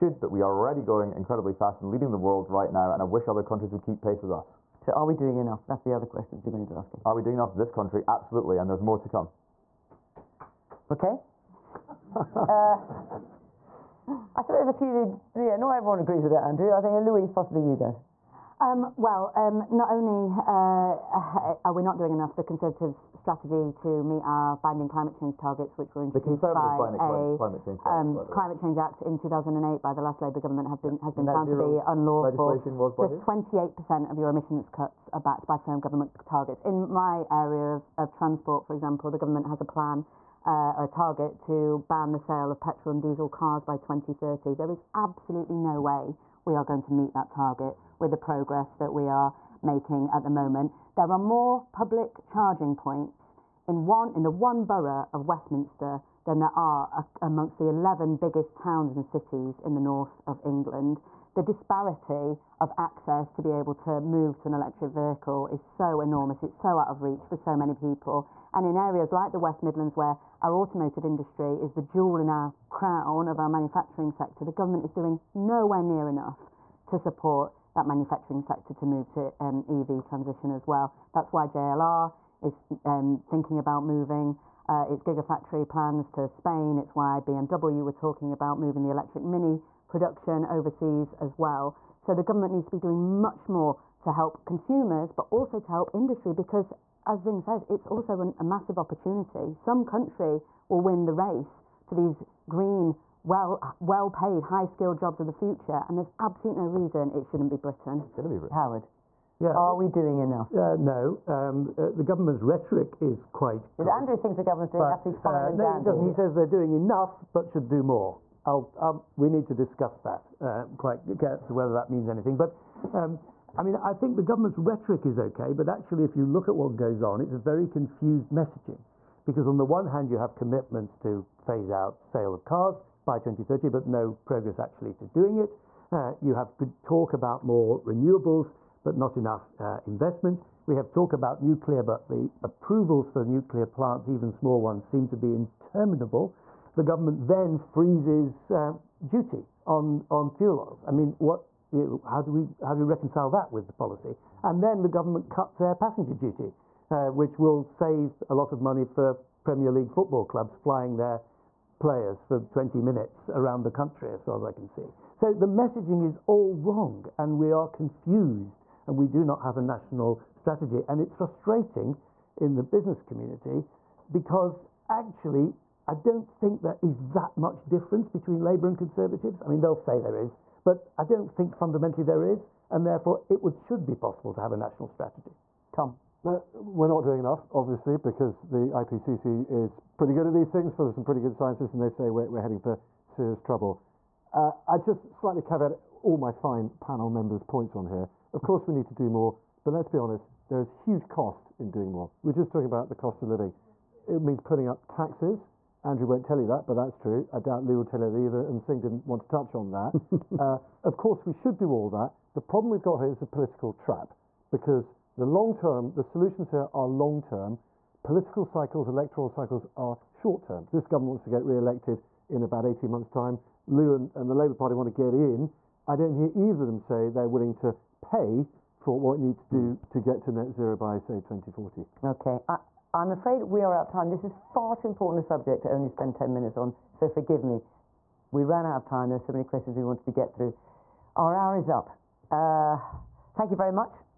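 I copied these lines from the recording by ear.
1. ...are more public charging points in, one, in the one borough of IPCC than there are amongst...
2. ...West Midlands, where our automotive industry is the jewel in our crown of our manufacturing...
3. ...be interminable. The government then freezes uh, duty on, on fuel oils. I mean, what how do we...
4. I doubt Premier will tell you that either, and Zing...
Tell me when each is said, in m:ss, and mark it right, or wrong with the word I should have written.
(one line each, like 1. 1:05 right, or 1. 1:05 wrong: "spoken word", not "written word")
1. 0:51 wrong: "Westminster", not "IPCC"
2. 1:09 right
3. 2:25 right
4. 3:27 wrong: "Lou", not "Premier".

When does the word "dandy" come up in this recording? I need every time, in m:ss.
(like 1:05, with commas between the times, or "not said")
1:55.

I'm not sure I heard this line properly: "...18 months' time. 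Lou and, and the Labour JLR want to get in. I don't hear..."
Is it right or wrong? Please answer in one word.
wrong.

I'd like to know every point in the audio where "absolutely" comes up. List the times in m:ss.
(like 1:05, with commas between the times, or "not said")
0:08, 0:44, 1:46, 1:54.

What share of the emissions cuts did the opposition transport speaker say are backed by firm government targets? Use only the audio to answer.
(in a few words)
28%.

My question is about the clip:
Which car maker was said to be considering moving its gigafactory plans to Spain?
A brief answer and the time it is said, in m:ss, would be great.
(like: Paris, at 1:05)
JLR, at 1:21.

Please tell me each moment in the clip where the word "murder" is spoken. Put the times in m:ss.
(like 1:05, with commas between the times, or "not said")
not said.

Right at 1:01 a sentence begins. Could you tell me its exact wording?
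The disparity of access to be able to move to an electric vehicle is so enormous.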